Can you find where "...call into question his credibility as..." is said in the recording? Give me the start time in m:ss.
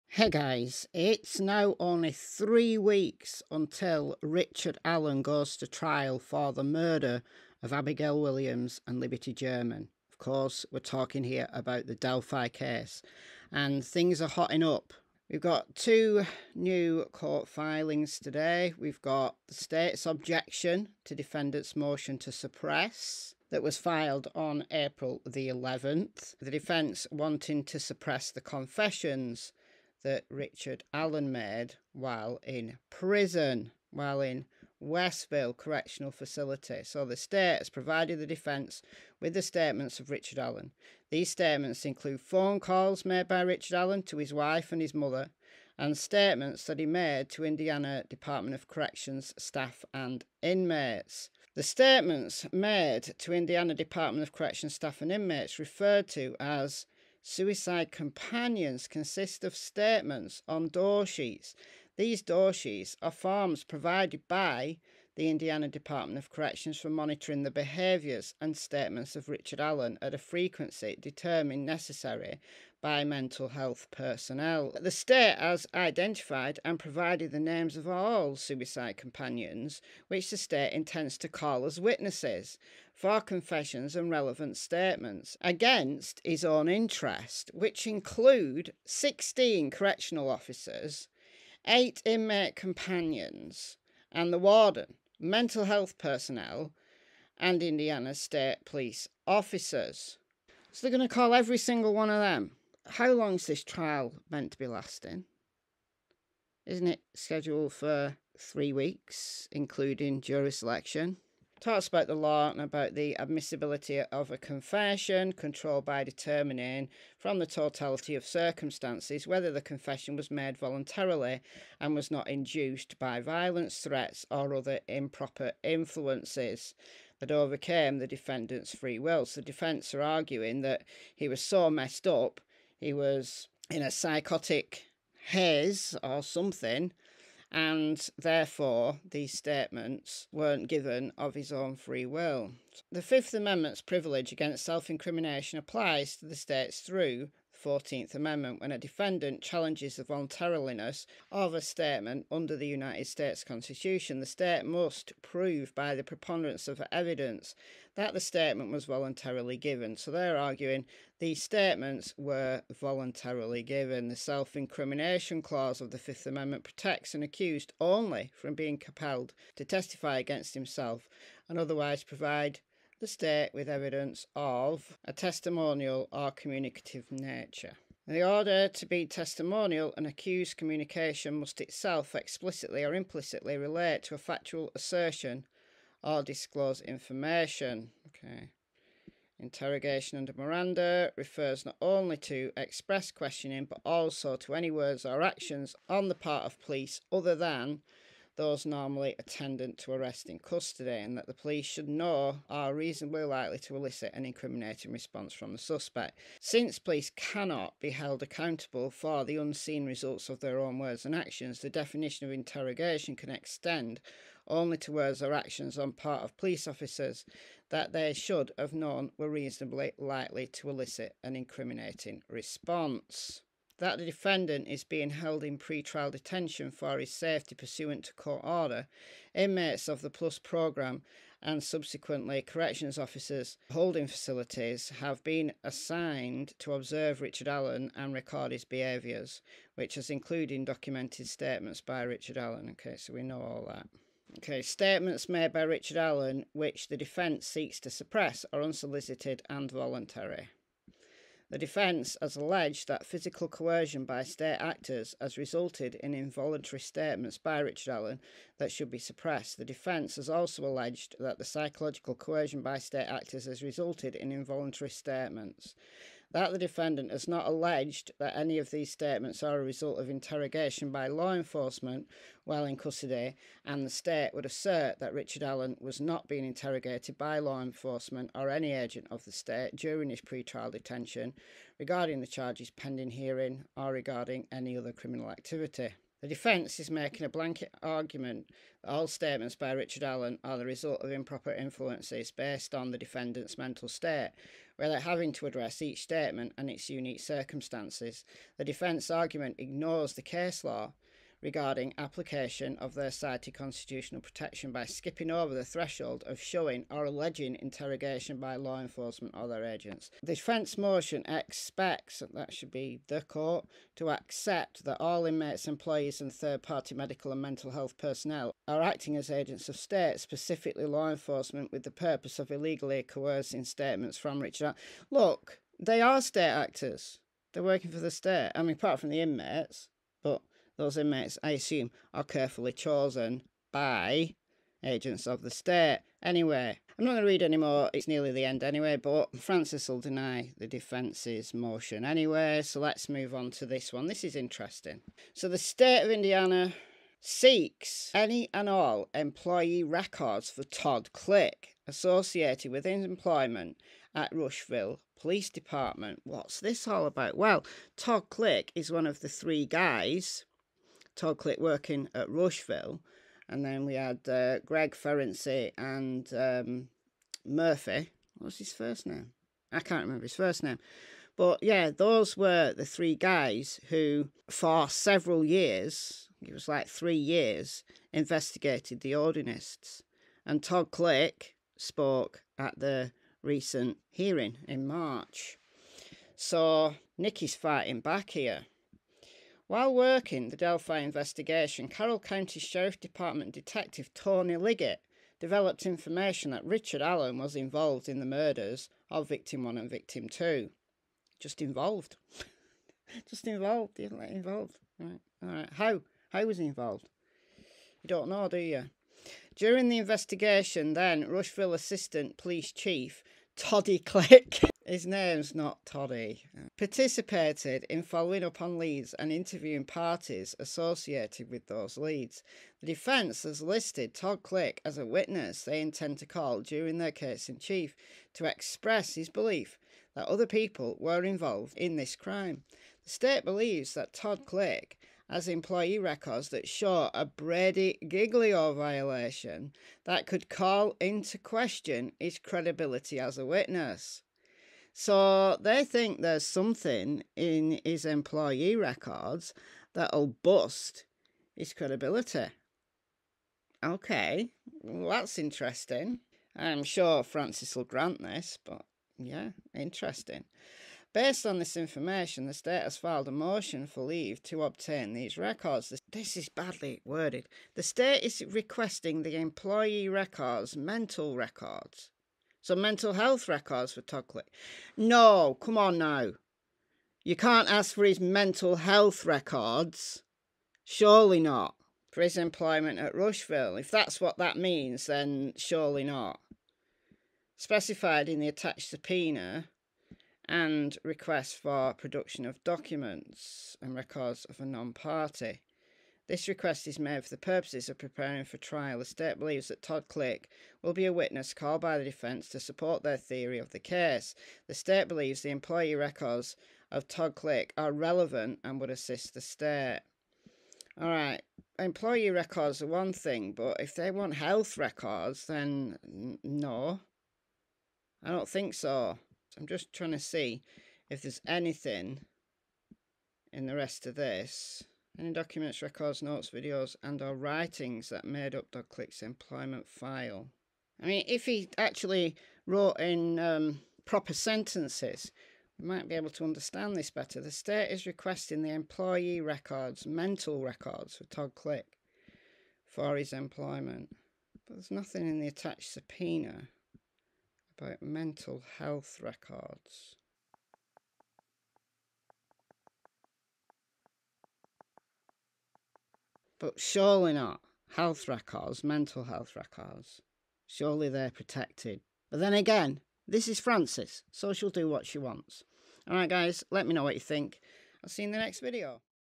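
7:20.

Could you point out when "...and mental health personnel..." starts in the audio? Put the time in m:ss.
5:17.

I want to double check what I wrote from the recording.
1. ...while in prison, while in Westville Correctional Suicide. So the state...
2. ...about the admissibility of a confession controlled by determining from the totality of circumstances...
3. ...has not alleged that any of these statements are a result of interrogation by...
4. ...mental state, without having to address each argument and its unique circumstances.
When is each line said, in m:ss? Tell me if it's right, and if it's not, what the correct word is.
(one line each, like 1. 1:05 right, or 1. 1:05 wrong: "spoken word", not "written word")
1. 0:31 wrong: "Facility", not "Suicide"
2. 1:52 right
3. 4:27 right
4. 4:53 wrong: "statement", not "argument".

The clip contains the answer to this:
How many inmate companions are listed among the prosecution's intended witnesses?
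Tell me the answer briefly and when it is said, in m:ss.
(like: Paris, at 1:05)
8, at 1:31.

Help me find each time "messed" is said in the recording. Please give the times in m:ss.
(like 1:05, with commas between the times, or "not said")
2:11.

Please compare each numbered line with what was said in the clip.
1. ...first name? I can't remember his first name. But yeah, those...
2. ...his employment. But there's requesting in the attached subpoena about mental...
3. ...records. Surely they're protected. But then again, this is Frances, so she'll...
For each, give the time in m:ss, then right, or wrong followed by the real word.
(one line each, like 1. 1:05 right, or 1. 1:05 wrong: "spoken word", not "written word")
1. 6:08 right
2. 9:03 wrong: "nothing", not "requesting"
3. 9:19 right.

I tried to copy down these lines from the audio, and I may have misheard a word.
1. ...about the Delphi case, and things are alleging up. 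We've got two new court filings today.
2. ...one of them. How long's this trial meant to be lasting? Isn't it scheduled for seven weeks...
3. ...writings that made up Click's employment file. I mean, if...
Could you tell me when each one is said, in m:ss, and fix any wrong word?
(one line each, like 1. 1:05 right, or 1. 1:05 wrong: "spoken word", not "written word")
1. 0:11 wrong: "hotting", not "alleging"
2. 1:41 wrong: "three", not "seven"
3. 8:47 right.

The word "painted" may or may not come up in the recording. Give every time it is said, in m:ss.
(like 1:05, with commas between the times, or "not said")
not said.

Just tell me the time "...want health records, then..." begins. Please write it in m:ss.
8:34.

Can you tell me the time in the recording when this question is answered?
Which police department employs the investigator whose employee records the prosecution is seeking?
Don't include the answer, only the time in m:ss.
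5:54.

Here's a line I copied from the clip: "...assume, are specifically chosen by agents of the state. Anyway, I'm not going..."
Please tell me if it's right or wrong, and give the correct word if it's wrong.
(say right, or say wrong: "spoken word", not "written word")
wrong: "carefully", not "specifically".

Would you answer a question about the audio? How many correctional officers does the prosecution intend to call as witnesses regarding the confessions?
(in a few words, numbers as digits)
16.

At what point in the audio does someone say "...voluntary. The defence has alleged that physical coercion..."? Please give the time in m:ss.
4:09.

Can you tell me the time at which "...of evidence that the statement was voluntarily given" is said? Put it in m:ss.
2:36.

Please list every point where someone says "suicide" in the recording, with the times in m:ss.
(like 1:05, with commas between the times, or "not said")
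0:57, 1:18.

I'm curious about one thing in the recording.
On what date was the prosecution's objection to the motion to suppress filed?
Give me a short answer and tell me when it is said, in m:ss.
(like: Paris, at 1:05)
April 11th, at 0:24.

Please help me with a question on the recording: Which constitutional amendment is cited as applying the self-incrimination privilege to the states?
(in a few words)
14th Amendment.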